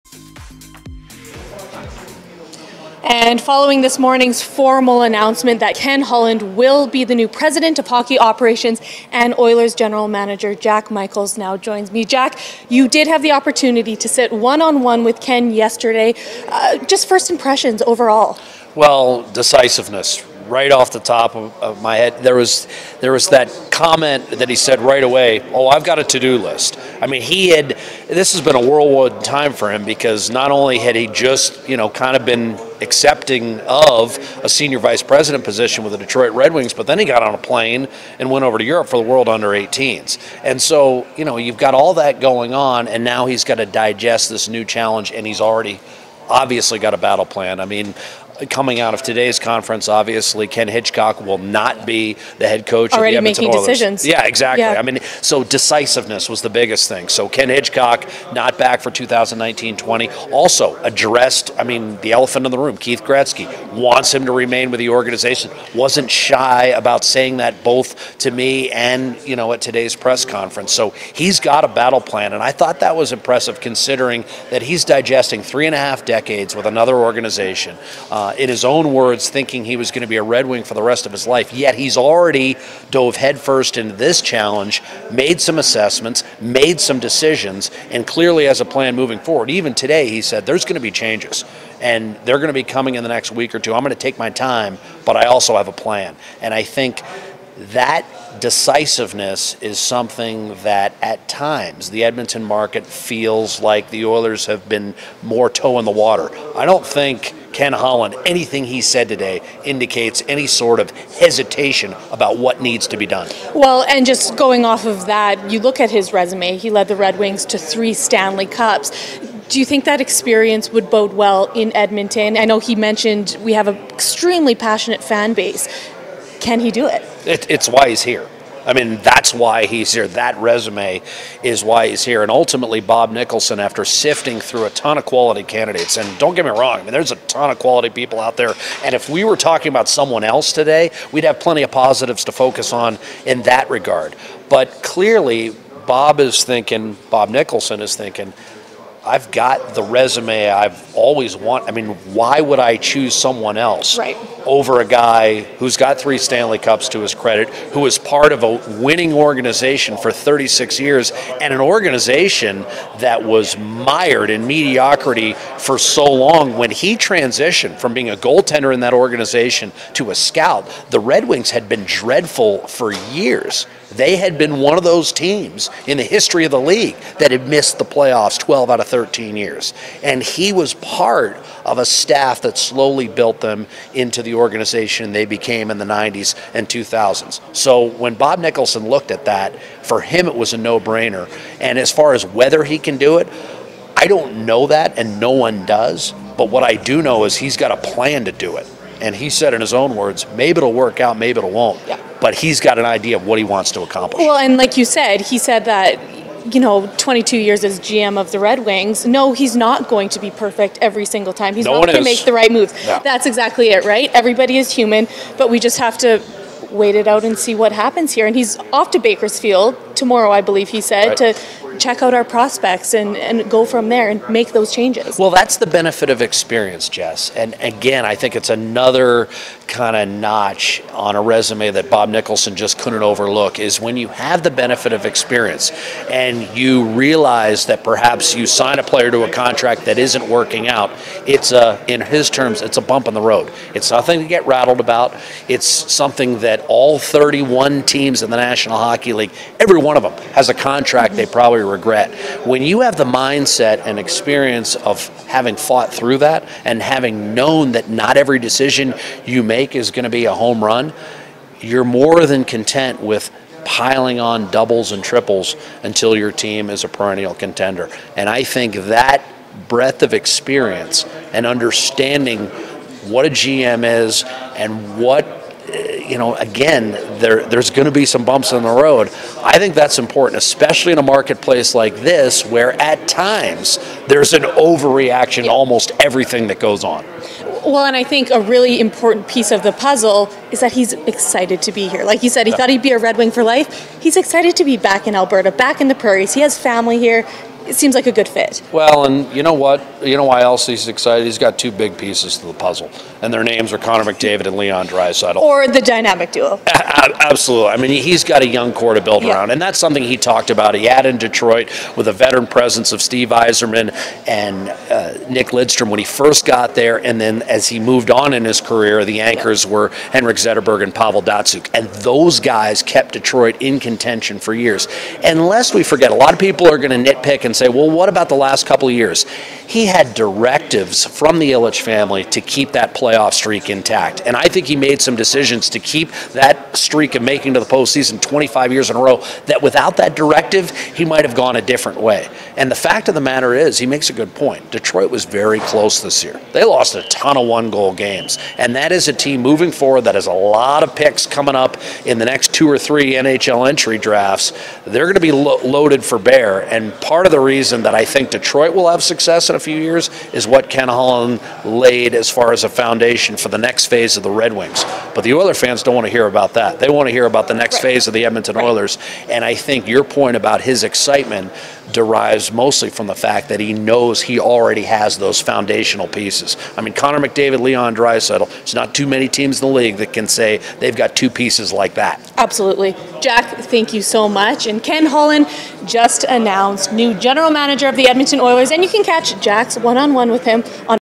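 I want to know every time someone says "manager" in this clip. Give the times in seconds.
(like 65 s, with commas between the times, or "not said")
10 s, 387 s.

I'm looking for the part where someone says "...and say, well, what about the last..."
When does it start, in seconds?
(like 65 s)
327 s.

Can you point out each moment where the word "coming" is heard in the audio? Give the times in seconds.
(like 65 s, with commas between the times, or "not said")
48 s, 92 s, 351 s.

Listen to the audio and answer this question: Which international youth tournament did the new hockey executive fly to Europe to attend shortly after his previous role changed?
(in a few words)
World Under 18s.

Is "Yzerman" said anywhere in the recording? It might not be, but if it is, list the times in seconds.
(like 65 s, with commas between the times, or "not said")
313 s.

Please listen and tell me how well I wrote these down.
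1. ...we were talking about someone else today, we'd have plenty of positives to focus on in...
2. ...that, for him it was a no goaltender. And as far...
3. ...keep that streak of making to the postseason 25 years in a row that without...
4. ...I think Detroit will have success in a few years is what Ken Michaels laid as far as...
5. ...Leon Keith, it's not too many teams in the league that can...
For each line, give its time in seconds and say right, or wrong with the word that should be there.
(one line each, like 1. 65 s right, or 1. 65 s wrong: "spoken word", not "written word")
1. 139 s right
2. 189 s wrong: "brainer", not "goaltender"
3. 335 s right
4. 357 s wrong: "Holland", not "Michaels"
5. 377 s wrong: "Draisaitl", not "Keith".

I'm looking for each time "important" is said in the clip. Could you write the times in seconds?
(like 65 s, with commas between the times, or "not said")
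279 s, 288 s.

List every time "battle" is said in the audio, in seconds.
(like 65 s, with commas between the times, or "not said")
46 s, 71 s.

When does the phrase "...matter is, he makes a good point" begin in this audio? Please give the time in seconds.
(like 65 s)
343 s.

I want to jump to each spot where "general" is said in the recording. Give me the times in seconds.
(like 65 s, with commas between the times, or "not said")
9 s, 387 s.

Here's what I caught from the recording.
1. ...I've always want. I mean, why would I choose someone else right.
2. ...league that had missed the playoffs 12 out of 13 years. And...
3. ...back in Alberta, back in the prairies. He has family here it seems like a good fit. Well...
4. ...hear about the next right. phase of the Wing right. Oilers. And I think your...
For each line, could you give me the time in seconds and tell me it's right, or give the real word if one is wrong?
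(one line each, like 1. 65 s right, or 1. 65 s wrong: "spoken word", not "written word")
1. 150 s right
2. 176 s right
3. 294 s right
4. 367 s wrong: "Edmonton", not "Wing".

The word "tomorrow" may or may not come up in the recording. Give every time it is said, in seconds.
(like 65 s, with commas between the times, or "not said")
219 s.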